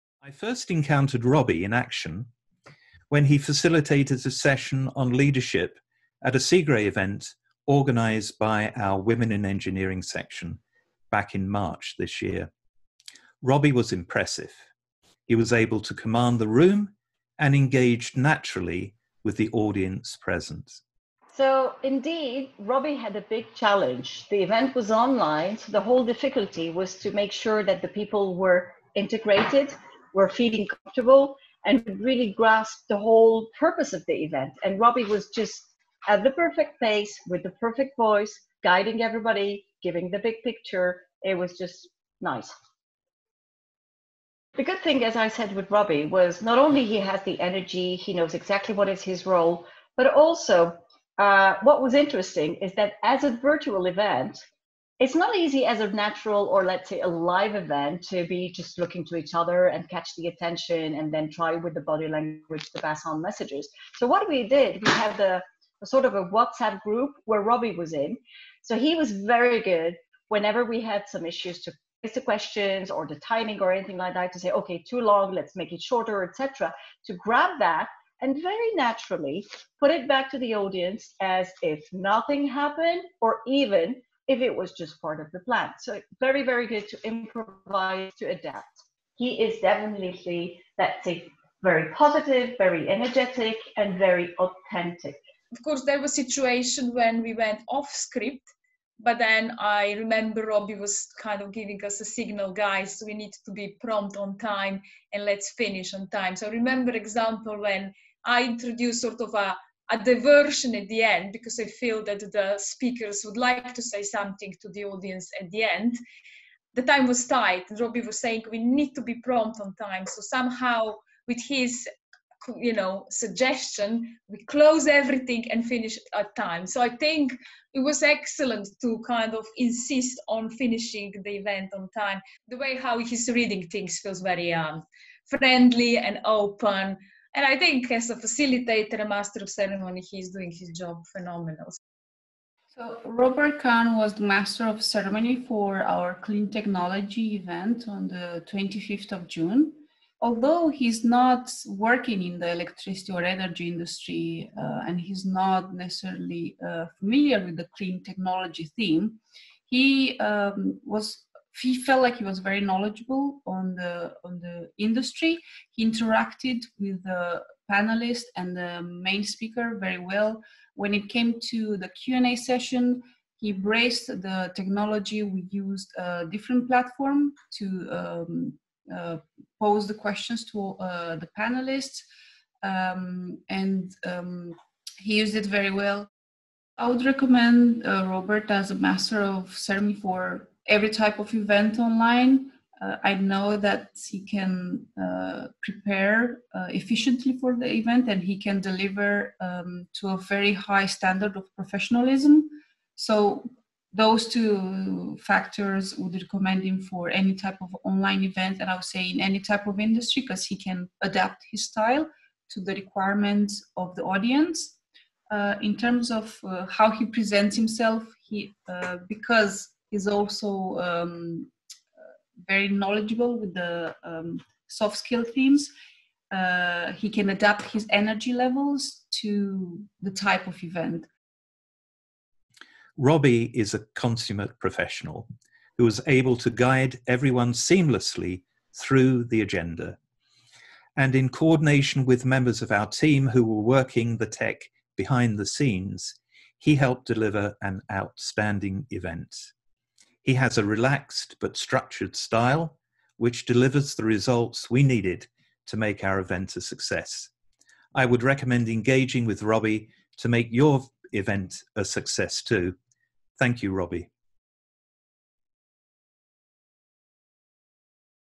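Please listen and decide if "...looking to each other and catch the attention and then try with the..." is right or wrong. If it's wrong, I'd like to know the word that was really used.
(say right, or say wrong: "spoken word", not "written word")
right.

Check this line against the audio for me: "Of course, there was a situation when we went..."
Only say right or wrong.
right.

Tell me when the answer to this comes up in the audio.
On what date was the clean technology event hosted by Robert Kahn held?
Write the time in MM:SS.
02:28.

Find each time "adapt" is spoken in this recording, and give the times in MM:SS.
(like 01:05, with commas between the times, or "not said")
01:28, 03:31, 03:47.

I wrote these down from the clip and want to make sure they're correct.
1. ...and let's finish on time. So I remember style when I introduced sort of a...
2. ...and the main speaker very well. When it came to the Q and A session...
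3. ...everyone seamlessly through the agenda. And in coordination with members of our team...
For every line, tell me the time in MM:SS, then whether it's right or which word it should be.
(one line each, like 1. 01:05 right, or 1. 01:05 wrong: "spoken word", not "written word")
1. 01:45 wrong: "example", not "style"
2. 02:48 right
3. 03:57 right.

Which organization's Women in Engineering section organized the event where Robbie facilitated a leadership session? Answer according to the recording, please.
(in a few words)
CIGRE.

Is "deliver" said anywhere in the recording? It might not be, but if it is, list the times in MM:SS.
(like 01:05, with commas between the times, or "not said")
03:18, 04:07, 04:13.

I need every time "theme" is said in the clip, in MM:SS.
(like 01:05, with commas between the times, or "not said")
02:38, 03:45.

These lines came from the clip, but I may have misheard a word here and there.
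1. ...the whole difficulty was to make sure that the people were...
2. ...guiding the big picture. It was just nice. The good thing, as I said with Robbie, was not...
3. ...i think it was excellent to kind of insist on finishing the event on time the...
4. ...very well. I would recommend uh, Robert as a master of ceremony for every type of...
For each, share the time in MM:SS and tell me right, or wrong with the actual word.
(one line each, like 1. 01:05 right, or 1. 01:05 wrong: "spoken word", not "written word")
1. 00:25 right
2. 00:39 wrong: "giving", not "guiding"
3. 02:06 right
4. 03:05 right.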